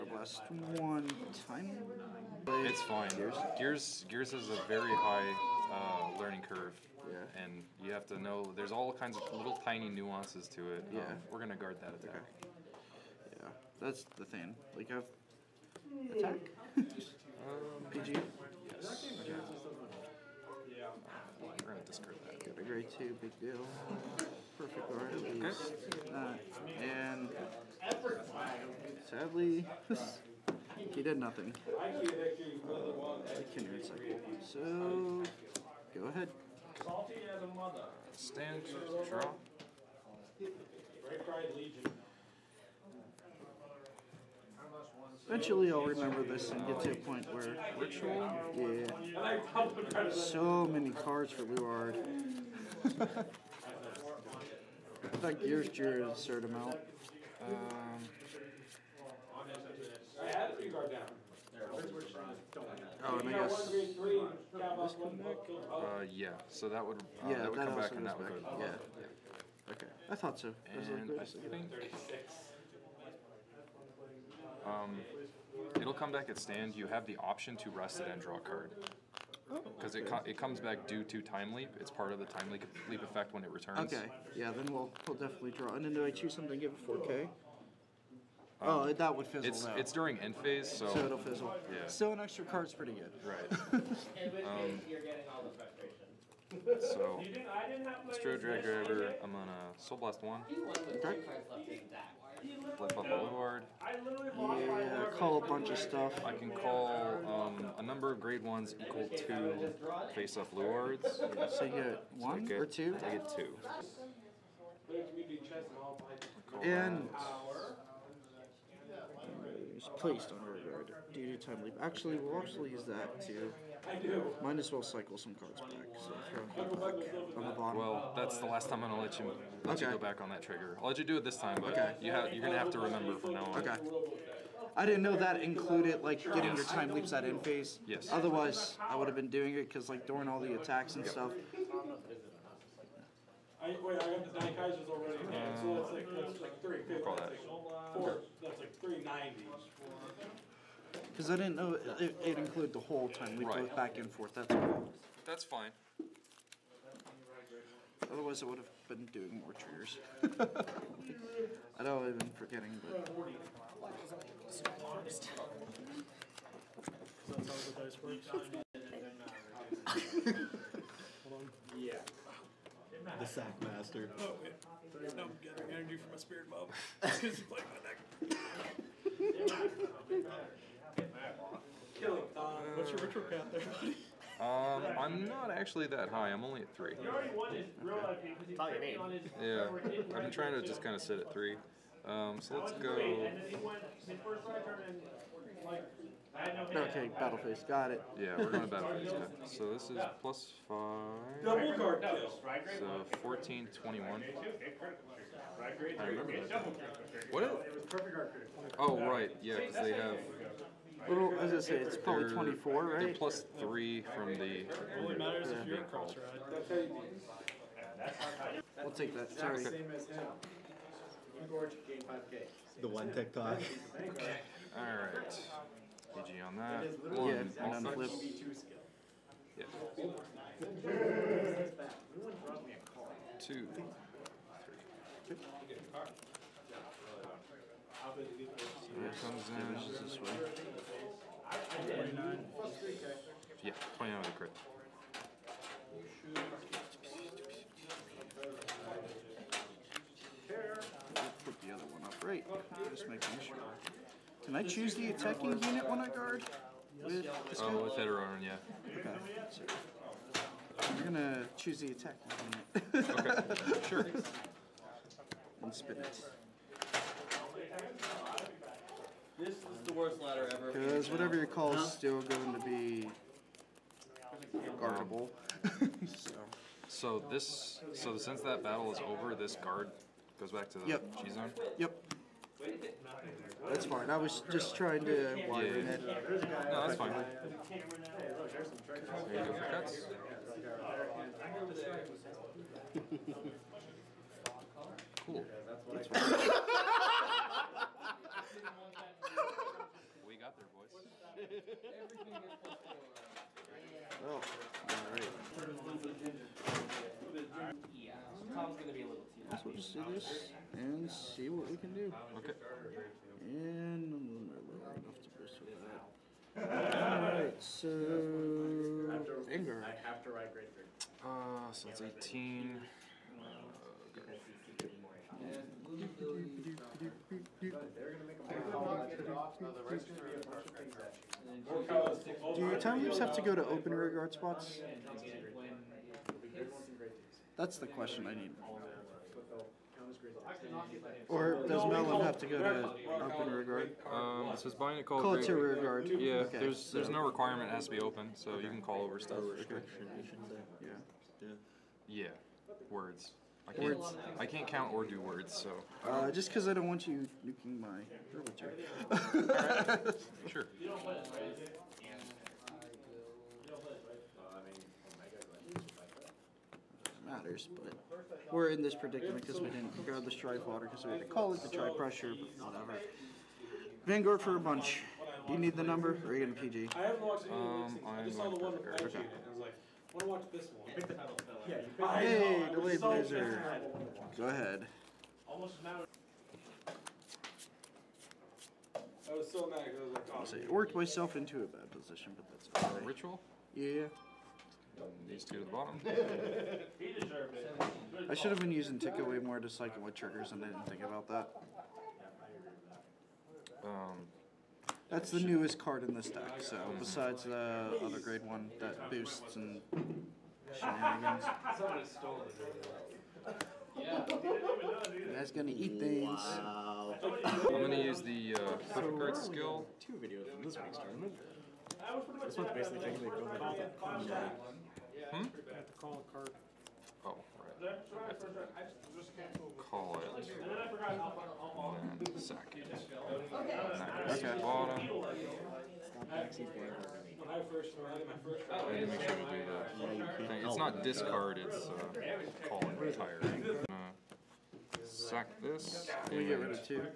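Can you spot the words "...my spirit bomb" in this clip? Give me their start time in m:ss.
2:56.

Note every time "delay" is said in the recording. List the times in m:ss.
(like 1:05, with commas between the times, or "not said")
6:22.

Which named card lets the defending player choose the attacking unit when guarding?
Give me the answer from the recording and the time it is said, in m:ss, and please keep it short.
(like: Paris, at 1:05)
Eterorin, at 4:17.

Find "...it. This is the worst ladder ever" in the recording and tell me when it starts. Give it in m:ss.
4:25.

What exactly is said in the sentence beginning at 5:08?
Tom's gonna be a little too.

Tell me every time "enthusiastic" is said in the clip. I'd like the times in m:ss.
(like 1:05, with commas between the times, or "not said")
not said.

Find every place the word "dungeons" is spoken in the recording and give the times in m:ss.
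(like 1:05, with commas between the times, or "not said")
not said.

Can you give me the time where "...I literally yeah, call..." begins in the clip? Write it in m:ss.
1:43.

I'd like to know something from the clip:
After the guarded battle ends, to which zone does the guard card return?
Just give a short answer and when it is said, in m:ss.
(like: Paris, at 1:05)
G zone, at 4:41.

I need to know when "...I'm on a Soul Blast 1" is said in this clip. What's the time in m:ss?
1:39.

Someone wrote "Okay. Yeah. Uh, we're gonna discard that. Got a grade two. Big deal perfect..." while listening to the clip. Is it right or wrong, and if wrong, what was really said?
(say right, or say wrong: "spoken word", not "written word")
right.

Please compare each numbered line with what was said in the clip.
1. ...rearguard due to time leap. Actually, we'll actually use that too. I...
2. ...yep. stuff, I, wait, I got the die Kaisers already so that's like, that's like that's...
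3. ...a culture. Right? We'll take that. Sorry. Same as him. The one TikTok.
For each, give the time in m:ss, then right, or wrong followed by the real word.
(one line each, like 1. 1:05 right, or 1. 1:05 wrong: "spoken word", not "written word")
1. 2:00 right
2. 2:21 right
3. 3:35 right.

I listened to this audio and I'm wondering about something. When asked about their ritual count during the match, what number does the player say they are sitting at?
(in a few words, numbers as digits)
3.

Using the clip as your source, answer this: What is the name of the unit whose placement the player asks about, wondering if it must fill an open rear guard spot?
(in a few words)
Melon.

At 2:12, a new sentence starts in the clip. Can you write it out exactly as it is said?
you have, you're gonna have to remember from now on.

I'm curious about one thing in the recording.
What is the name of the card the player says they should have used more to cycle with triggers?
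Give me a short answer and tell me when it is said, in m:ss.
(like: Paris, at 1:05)
tick away, at 6:38.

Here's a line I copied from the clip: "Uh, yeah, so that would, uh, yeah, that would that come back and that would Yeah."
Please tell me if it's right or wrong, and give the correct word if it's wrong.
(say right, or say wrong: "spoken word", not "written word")
right.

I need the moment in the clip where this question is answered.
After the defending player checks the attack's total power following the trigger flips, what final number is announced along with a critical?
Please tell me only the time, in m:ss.
4:03.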